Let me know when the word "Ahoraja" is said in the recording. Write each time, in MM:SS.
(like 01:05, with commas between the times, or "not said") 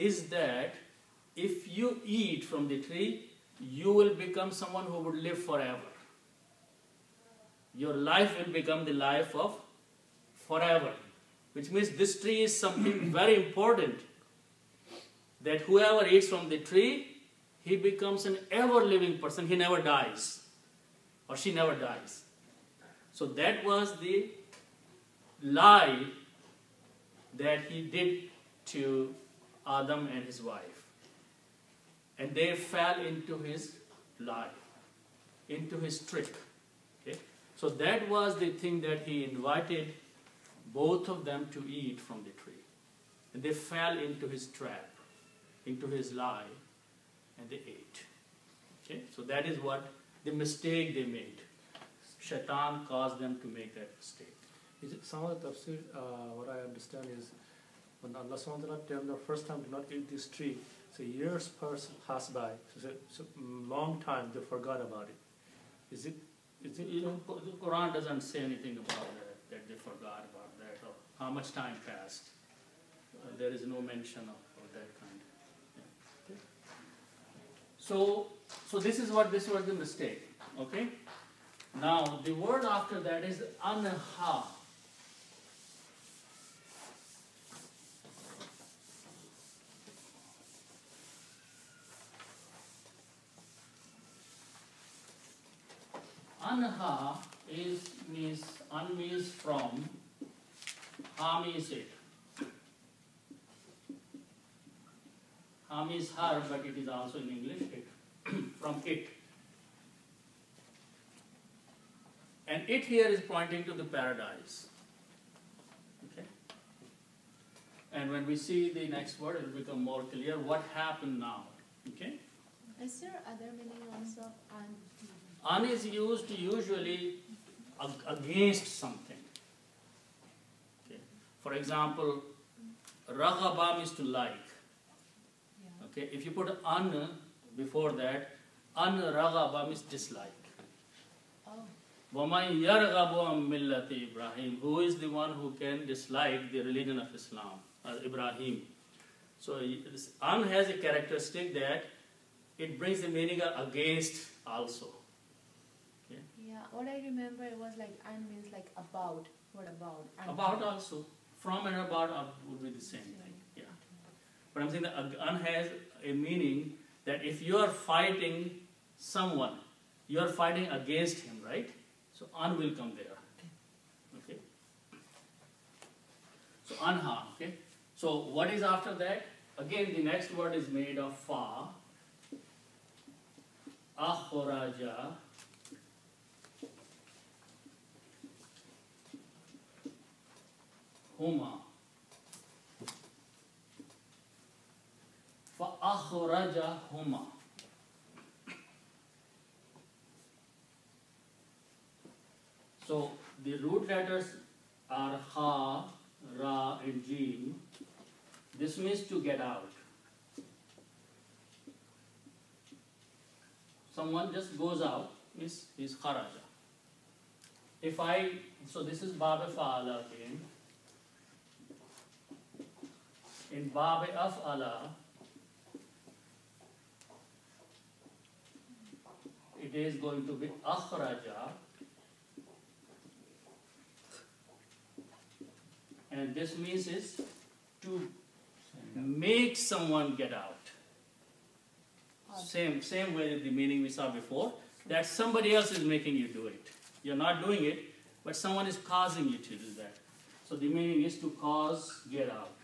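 03:03.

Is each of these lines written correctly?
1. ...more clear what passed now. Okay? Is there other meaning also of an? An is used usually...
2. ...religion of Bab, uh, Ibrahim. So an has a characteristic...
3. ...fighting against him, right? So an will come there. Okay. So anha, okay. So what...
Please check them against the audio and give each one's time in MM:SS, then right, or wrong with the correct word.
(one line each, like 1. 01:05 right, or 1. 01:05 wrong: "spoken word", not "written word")
1. 01:59 wrong: "happened", not "passed"
2. 02:26 wrong: "Islam", not "Bab"
3. 02:50 right.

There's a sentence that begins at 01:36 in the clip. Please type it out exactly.
Anha is means un means from, ha means it.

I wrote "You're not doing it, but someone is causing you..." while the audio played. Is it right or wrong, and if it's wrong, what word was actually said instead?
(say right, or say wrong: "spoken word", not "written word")
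right.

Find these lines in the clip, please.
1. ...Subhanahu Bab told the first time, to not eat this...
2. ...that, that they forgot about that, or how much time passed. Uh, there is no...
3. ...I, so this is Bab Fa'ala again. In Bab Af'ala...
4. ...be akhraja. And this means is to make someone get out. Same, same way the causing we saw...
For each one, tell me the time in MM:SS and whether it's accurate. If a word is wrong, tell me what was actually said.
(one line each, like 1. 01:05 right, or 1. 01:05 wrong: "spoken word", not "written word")
1. 00:58 wrong: "Taala", not "Bab"
2. 01:09 right
3. 03:37 right
4. 03:50 wrong: "meaning", not "causing".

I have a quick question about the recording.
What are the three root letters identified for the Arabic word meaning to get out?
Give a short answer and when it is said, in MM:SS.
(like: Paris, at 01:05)
Ha, Ra and Jim, at 03:25.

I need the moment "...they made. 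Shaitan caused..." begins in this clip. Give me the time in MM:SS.
00:50.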